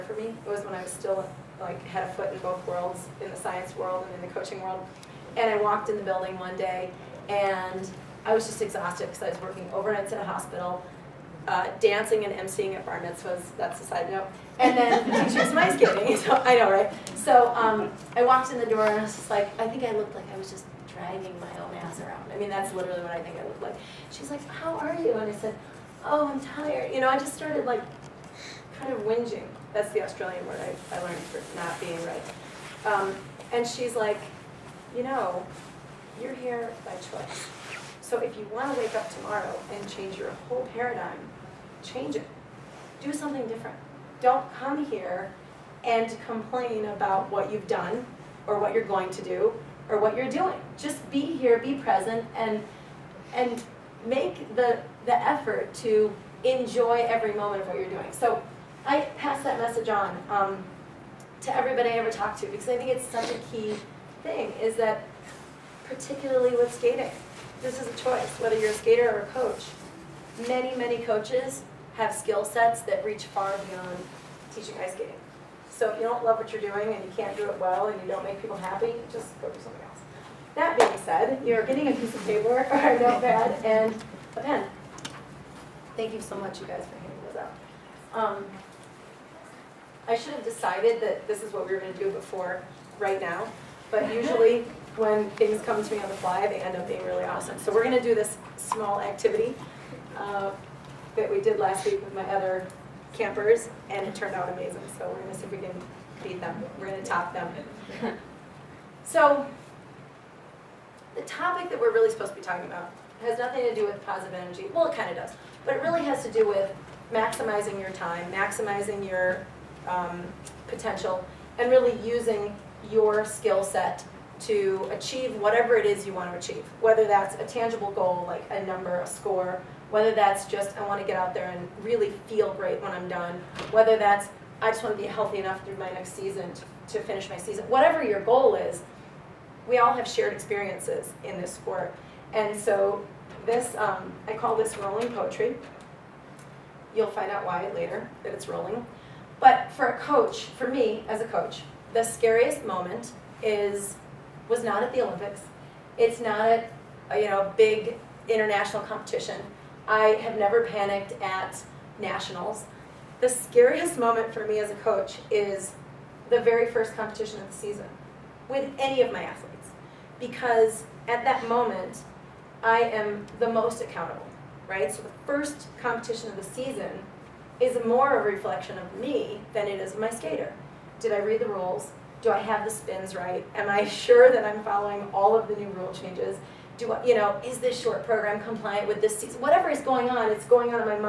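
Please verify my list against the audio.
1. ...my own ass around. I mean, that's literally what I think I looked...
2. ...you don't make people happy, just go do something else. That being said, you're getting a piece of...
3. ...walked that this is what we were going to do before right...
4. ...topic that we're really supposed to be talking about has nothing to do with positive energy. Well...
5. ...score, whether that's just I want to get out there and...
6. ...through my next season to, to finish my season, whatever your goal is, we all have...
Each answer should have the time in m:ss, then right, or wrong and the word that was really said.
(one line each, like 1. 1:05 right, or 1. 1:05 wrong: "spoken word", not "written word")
1. 0:21 right
2. 1:18 right
3. 1:30 wrong: "decided", not "walked"
4. 1:51 right
5. 2:09 right
6. 2:15 right.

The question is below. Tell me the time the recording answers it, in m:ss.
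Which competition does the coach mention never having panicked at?
2:41.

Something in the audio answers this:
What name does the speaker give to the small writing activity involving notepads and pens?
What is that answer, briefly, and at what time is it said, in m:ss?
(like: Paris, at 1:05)
rolling poetry, at 2:24.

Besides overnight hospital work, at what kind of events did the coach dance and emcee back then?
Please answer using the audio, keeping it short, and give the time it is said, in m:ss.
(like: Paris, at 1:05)
bar mitzvahs, at 0:12.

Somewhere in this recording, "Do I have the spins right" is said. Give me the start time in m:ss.
3:02.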